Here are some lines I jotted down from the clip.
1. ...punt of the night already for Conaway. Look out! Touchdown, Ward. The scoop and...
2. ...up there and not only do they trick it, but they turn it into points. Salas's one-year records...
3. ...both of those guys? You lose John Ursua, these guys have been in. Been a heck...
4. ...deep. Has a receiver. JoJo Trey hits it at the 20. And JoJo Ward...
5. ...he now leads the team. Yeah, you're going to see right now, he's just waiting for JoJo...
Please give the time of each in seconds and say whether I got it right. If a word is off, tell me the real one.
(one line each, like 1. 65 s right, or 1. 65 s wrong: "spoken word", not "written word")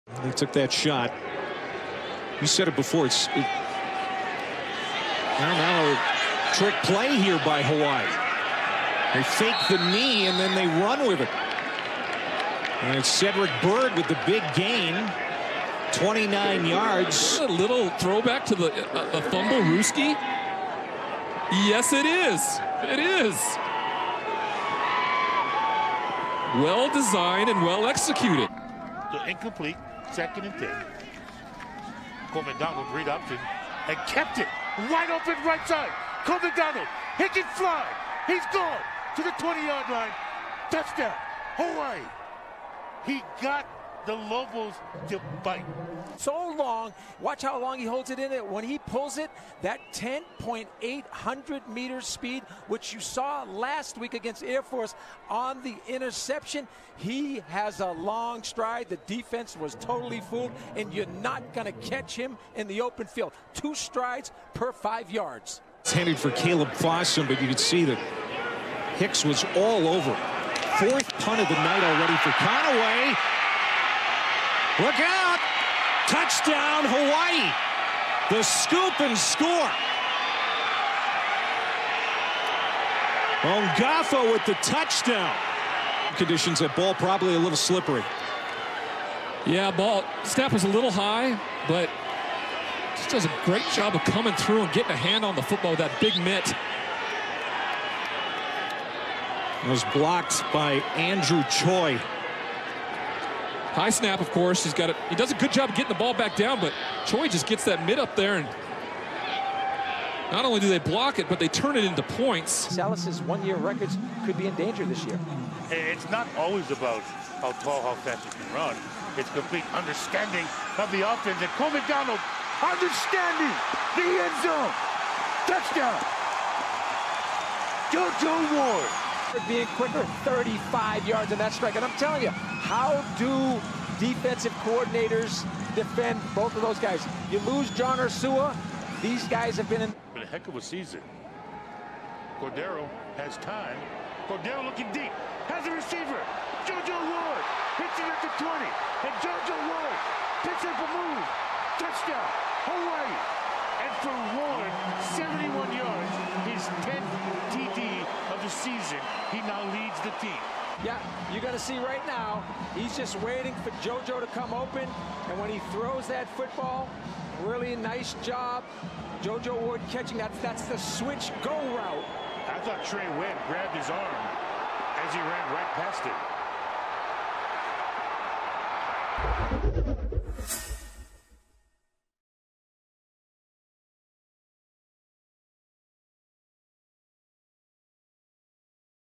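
1. 71 s wrong: "Hawaii", not "Ward"
2. 107 s wrong: "block", not "trick"
3. 136 s right
4. 144 s wrong: "Ward", not "Trey"
5. 159 s right.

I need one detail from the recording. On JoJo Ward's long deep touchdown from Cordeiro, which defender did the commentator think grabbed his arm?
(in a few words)
Trey Webb.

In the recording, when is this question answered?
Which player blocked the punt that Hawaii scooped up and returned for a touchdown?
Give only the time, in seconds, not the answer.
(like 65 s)
100 s.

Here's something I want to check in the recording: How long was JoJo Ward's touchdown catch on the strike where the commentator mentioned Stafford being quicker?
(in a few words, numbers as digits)
35 yards.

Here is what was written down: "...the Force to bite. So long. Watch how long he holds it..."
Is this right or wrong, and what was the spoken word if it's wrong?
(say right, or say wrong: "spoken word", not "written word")
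wrong: "Lobos", not "Force".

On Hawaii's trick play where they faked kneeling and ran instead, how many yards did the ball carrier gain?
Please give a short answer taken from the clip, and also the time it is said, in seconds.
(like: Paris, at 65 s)
29, at 15 s.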